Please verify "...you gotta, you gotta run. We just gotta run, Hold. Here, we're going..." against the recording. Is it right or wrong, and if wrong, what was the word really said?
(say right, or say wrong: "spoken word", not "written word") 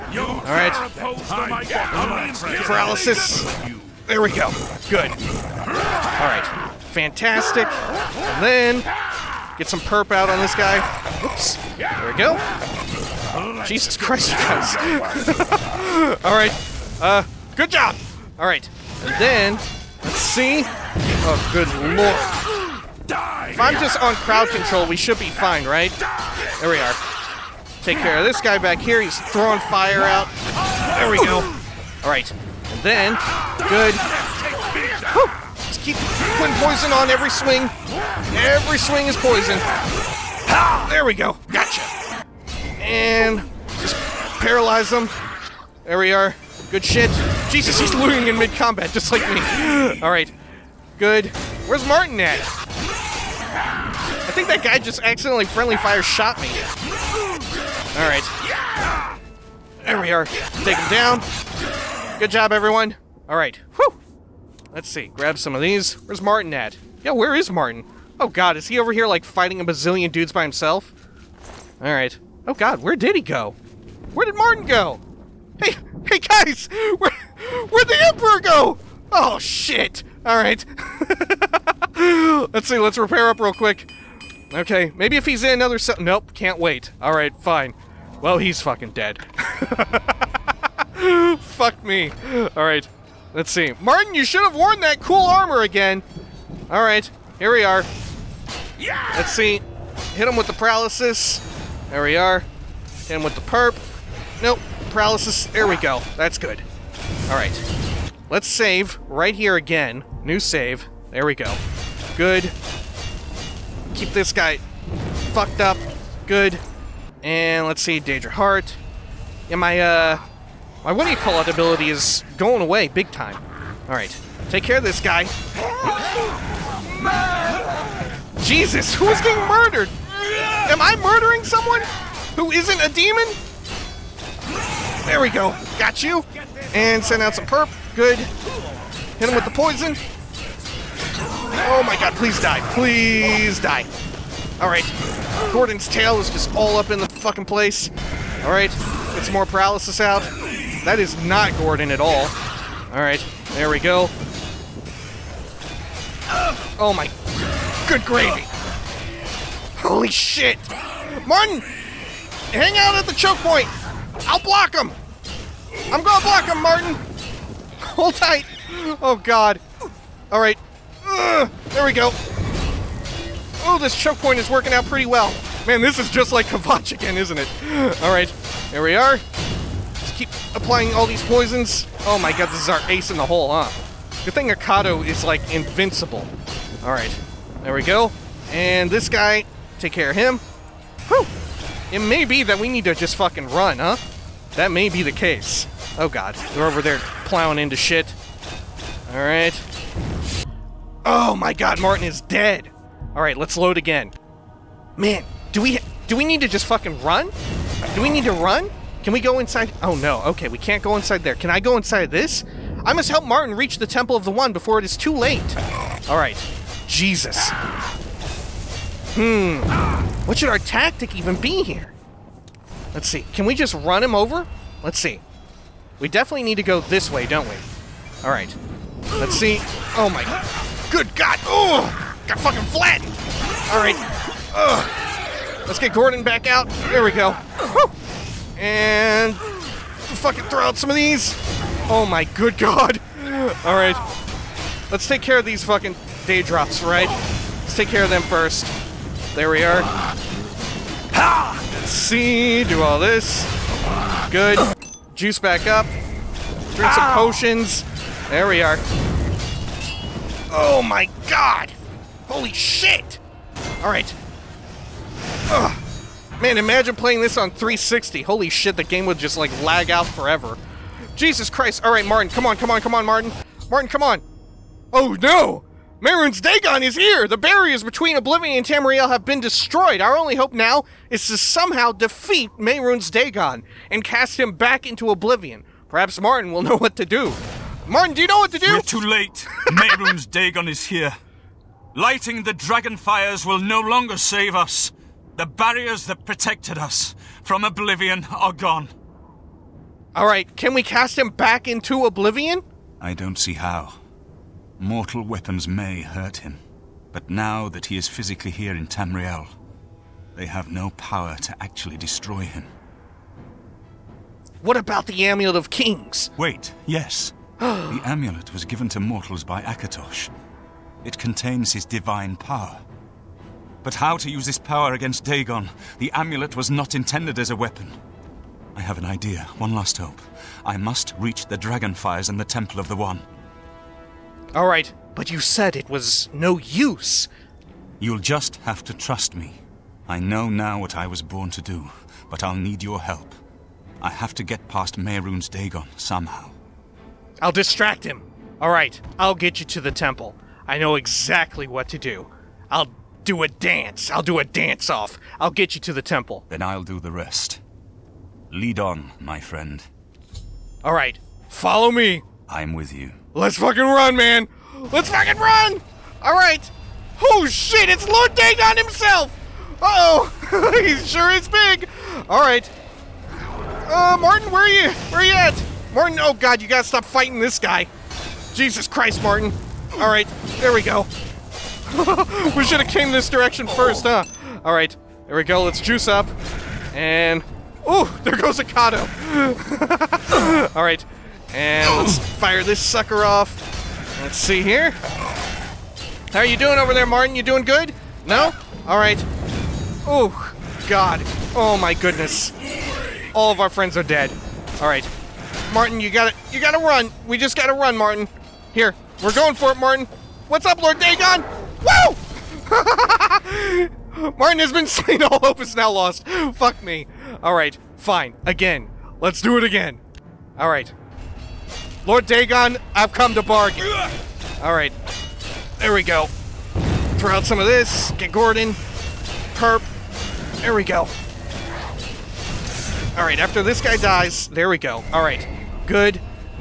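wrong: "Martin", not "Hold".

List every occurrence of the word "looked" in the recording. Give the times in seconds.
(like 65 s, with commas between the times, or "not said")
not said.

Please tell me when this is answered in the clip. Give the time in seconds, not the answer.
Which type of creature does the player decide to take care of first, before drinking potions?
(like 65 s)
246 s.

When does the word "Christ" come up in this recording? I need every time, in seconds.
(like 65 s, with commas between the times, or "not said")
13 s, 271 s, 378 s.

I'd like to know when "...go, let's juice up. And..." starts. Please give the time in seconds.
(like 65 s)
385 s.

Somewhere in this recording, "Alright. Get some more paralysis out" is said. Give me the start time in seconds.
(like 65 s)
148 s.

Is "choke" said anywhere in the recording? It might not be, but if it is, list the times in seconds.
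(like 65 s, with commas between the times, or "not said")
163 s, 173 s.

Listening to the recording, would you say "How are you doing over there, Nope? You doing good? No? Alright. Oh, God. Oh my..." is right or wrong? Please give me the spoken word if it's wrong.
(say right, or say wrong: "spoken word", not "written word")
wrong: "Martin", not "Nope".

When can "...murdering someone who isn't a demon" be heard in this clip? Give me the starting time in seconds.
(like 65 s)
131 s.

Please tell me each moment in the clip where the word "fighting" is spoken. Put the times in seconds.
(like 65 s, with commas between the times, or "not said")
69 s, 377 s.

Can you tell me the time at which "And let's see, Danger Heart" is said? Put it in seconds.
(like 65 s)
117 s.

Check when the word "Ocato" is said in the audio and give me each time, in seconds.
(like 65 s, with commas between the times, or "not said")
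184 s, 388 s.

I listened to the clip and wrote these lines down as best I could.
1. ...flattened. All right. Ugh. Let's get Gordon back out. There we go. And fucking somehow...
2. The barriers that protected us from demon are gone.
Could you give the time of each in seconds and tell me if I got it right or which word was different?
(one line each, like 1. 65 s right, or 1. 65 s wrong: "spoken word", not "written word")
1. 232 s wrong: "throw", not "somehow"
2. 295 s wrong: "oblivion", not "demon".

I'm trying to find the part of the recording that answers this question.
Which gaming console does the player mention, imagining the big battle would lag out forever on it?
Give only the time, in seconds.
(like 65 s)
267 s.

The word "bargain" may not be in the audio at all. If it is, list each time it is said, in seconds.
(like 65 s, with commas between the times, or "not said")
423 s.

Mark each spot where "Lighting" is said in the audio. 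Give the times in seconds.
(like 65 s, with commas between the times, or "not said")
291 s.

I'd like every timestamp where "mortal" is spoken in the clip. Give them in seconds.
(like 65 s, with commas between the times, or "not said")
304 s, 319 s.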